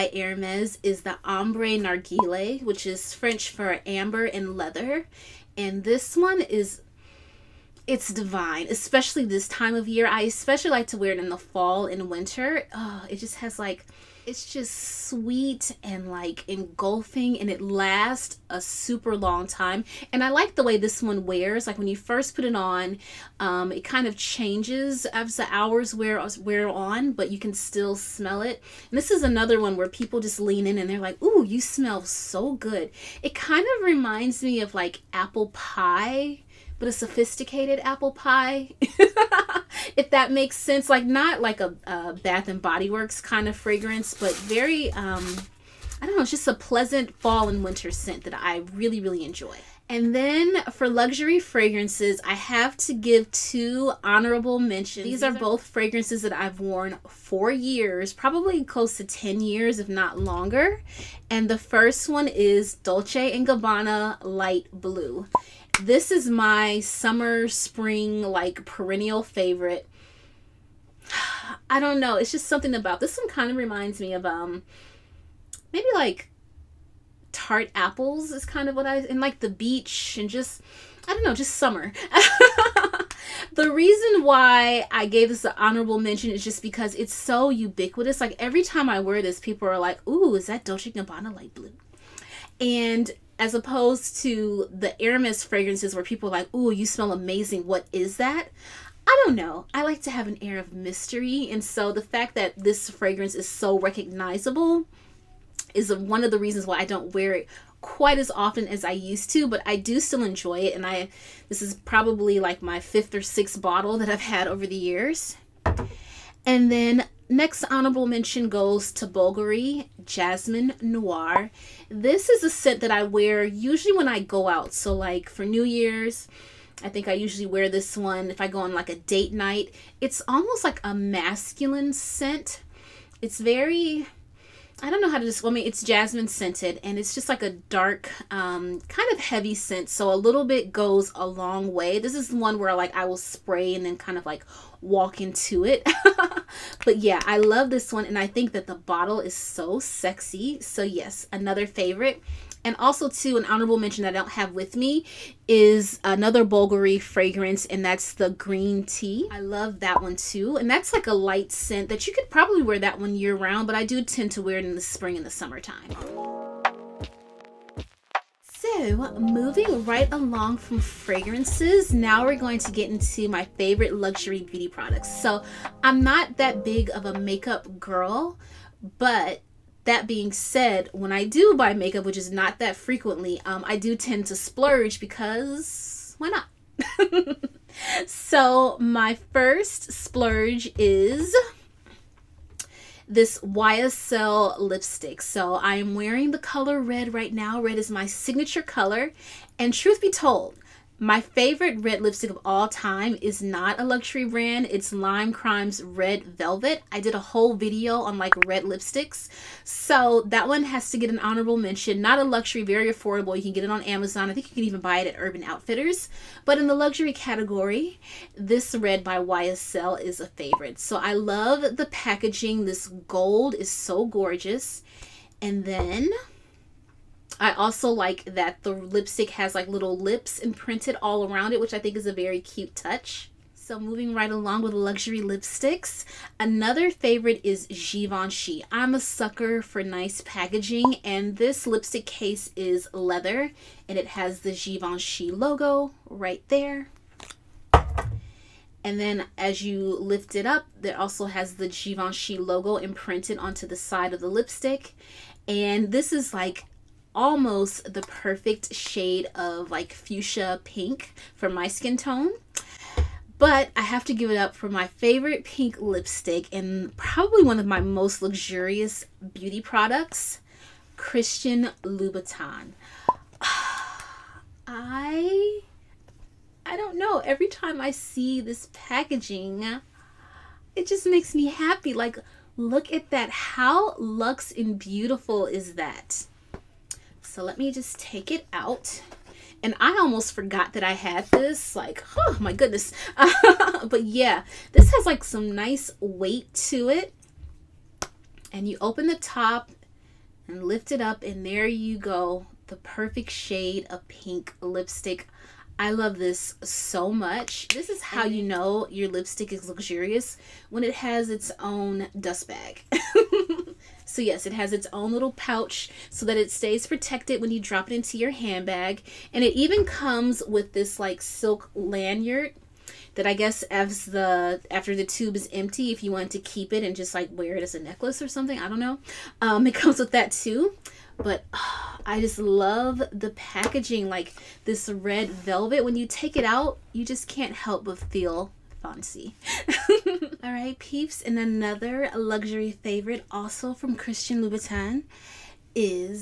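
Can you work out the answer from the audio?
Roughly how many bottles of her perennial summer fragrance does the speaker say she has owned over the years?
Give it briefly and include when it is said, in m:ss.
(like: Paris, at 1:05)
5 or 6, at 1:52.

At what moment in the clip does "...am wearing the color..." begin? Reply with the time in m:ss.
3:15.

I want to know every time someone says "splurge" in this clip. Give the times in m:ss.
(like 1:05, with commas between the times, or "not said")
3:04, 3:09.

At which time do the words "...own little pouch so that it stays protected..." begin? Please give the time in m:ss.
5:14.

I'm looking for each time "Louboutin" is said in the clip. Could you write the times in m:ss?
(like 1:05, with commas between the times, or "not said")
4:31, 5:44.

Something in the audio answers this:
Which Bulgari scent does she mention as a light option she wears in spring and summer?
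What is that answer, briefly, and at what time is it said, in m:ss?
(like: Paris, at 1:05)
green tea, at 2:38.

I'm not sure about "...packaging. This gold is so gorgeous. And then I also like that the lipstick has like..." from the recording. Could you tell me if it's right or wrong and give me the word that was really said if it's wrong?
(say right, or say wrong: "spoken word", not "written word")
right.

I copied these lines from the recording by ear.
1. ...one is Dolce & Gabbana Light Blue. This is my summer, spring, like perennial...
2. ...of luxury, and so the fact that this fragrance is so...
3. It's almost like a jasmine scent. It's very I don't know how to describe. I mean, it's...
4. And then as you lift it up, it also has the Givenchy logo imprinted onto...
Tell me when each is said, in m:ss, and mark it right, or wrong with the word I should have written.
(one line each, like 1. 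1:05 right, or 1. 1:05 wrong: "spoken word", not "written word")
1. 1:02 right
2. 1:40 wrong: "mystery", not "luxury"
3. 2:10 wrong: "masculine", not "jasmine"
4. 4:08 right.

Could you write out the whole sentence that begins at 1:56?
And then Next honorable mention goes to Bulgari Jasmine Noir.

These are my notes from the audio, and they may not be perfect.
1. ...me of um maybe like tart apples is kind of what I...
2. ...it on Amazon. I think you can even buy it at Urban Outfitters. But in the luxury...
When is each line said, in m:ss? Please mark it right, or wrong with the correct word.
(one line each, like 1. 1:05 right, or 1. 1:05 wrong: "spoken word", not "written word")
1. 1:14 right
2. 3:33 right.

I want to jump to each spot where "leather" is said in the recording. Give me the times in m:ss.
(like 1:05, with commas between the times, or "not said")
0:04, 4:02.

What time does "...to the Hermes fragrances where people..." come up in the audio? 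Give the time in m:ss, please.
1:34.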